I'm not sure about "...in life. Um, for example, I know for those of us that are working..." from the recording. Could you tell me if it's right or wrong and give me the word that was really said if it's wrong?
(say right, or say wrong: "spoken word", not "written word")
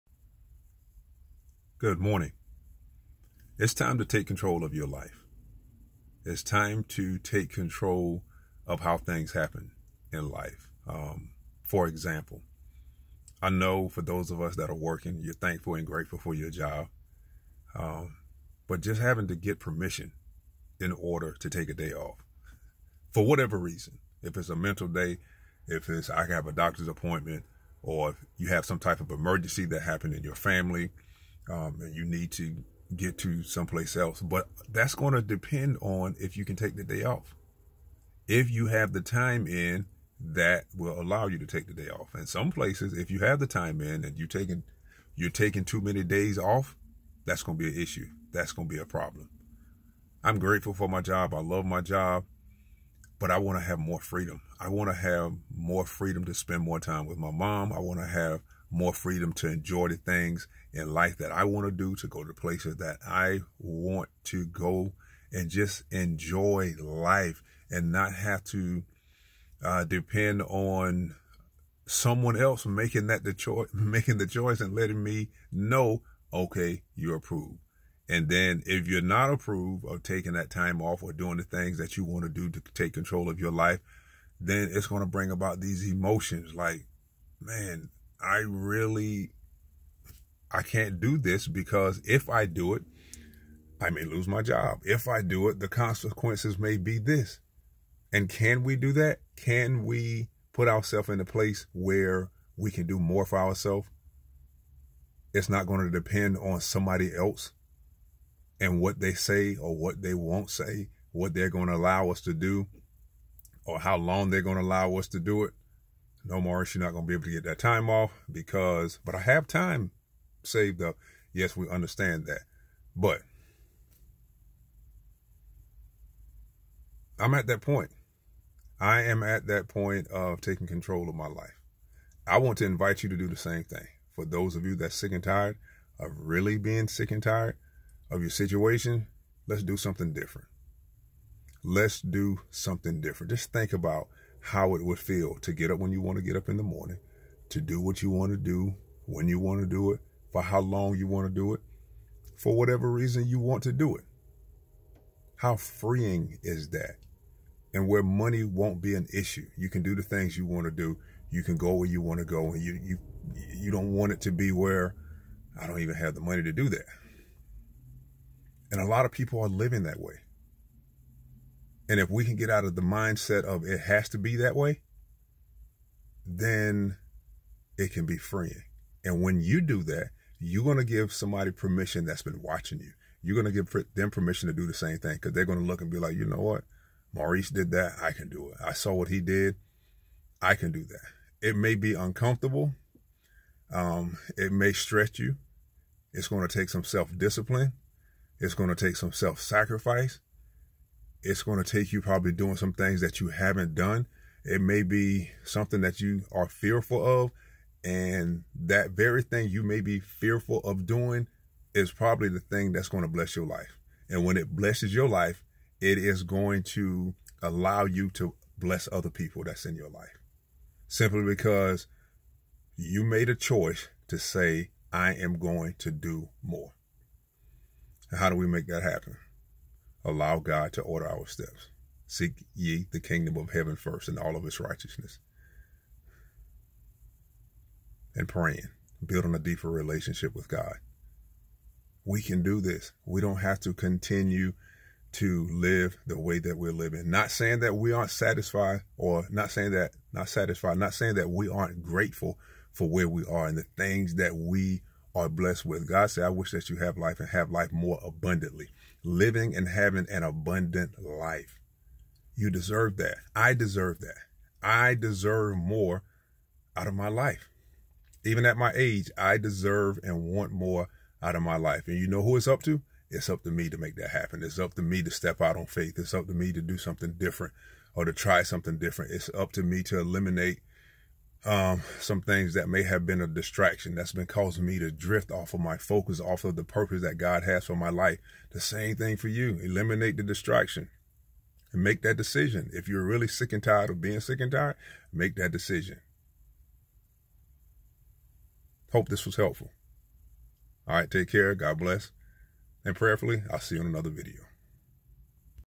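right.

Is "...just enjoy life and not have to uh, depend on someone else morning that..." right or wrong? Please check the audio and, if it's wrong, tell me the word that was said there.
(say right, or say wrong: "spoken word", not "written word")
wrong: "making", not "morning".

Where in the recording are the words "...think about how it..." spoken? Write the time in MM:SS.
02:23.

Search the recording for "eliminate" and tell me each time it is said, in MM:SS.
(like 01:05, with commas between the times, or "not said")
04:39, 04:49.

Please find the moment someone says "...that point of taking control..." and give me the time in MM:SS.
02:09.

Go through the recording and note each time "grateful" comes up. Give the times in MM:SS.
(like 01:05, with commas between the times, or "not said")
00:15, 00:50, 04:11.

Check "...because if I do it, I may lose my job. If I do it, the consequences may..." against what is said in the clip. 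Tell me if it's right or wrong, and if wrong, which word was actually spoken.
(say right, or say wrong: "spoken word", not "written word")
right.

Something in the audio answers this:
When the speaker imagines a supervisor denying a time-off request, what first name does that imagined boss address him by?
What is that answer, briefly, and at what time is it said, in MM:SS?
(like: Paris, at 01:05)
Morris, at 01:56.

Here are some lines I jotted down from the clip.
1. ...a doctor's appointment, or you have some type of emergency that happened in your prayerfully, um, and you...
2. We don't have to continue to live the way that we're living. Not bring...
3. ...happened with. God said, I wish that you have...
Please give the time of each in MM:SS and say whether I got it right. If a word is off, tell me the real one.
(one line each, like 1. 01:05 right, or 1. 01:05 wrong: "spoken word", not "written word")
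1. 00:26 wrong: "family", not "prayerfully"
2. 04:03 wrong: "saying", not "bring"
3. 04:15 wrong: "blessed", not "happened".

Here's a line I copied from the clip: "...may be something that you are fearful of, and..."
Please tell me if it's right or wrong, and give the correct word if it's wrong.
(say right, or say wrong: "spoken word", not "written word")
right.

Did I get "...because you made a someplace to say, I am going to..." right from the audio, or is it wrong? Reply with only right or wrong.
wrong.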